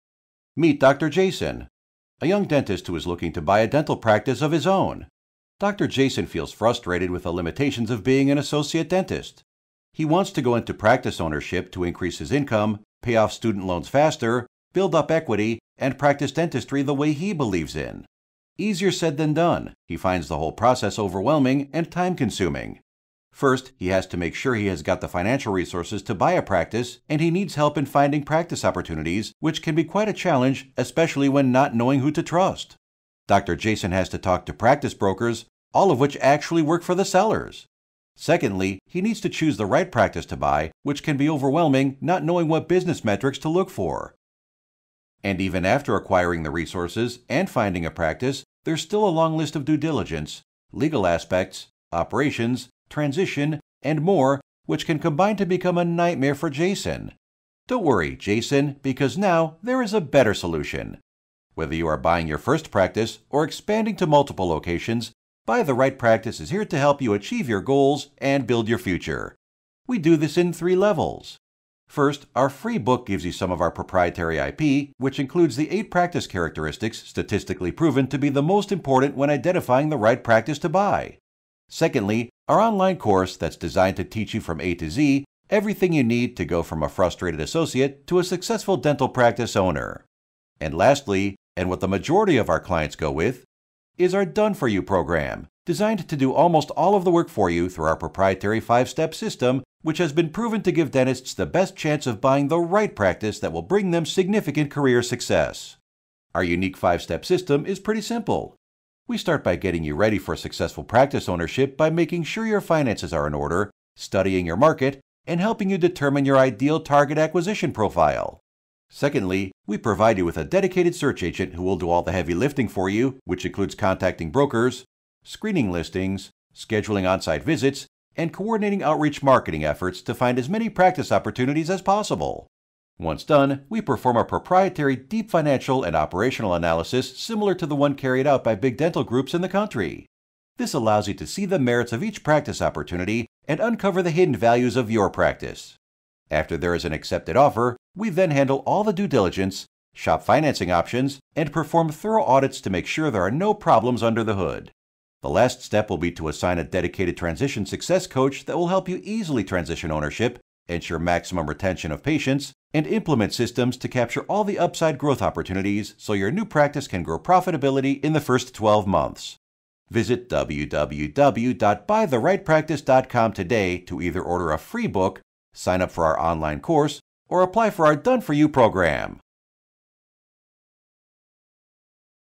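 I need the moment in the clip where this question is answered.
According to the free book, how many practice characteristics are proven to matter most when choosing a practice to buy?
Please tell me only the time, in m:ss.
1:15.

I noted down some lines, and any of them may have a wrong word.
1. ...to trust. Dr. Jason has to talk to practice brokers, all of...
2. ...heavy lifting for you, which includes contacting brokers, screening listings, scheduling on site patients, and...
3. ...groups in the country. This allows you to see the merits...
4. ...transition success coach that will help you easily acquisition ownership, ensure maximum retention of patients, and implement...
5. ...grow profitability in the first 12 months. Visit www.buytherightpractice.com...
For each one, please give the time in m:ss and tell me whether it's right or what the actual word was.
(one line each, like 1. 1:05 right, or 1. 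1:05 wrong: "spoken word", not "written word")
1. 0:32 right
2. 2:02 wrong: "visits", not "patients"
3. 2:19 right
4. 2:37 wrong: "transition", not "acquisition"
5. 2:47 right.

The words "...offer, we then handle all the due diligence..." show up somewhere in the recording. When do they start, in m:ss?
2:27.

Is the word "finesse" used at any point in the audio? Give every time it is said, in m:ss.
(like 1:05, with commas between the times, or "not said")
not said.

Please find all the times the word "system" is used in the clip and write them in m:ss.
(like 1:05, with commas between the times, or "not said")
1:39, 1:47, 2:43.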